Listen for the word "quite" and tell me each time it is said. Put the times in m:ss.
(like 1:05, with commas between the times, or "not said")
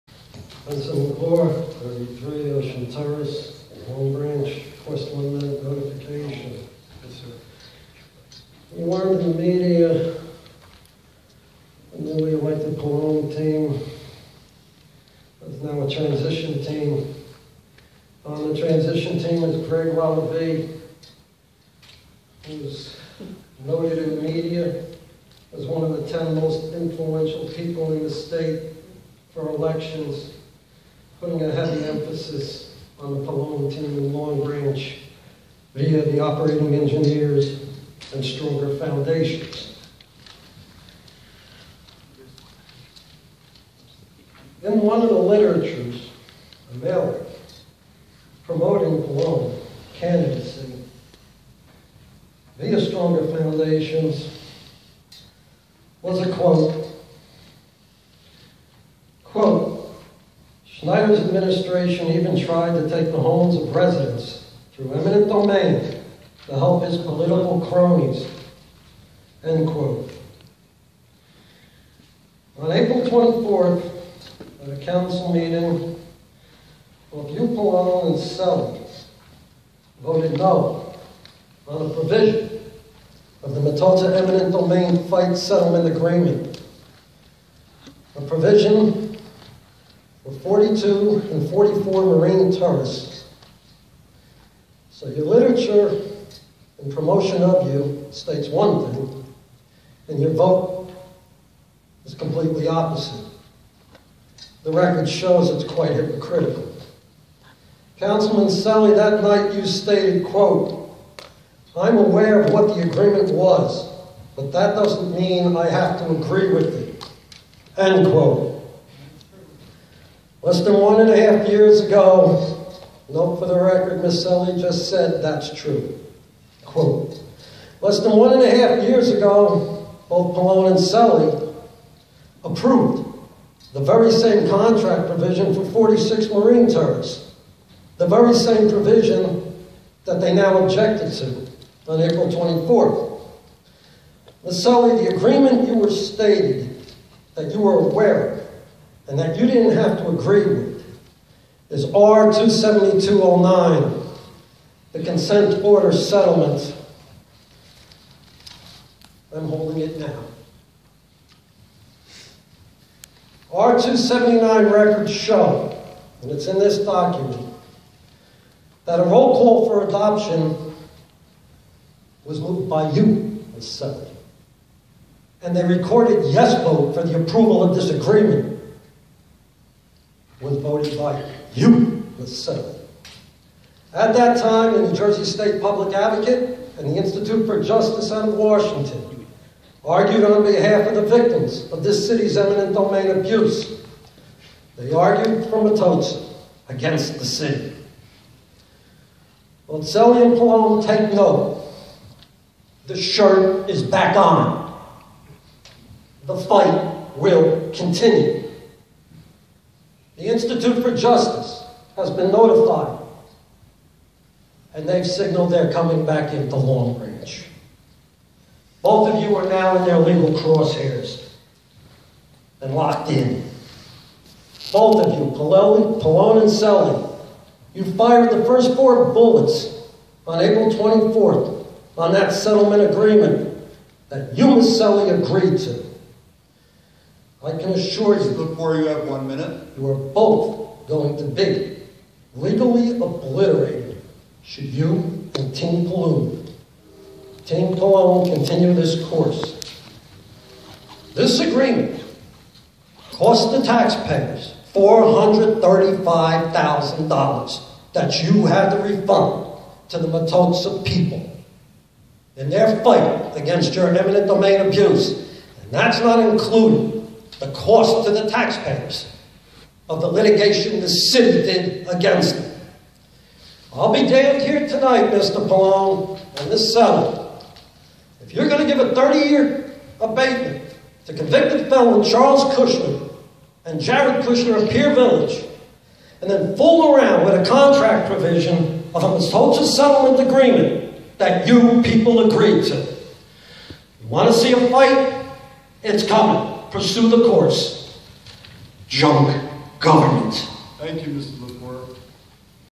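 1:45.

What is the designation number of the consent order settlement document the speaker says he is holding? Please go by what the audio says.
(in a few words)
R27209.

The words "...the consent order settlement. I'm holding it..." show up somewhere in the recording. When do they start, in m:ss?
2:34.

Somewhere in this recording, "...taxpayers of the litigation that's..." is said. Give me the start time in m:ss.
4:28.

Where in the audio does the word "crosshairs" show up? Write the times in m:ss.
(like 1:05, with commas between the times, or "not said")
3:40.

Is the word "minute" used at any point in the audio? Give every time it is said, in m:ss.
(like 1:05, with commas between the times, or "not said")
0:05, 3:59.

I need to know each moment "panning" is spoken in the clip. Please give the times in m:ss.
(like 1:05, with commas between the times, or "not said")
not said.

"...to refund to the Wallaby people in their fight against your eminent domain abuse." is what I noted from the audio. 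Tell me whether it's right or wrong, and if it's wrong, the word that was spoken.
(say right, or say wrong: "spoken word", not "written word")
wrong: "MTOTSA", not "Wallaby".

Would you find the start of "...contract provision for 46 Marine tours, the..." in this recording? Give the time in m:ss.
2:14.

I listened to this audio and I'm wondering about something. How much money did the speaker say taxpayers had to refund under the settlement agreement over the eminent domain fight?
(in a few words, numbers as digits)
$435,000.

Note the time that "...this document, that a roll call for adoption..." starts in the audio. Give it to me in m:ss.
2:46.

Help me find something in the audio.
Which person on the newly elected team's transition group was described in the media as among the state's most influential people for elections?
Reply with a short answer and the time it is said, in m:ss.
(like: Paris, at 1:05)
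Greg Wallaby, at 0:19.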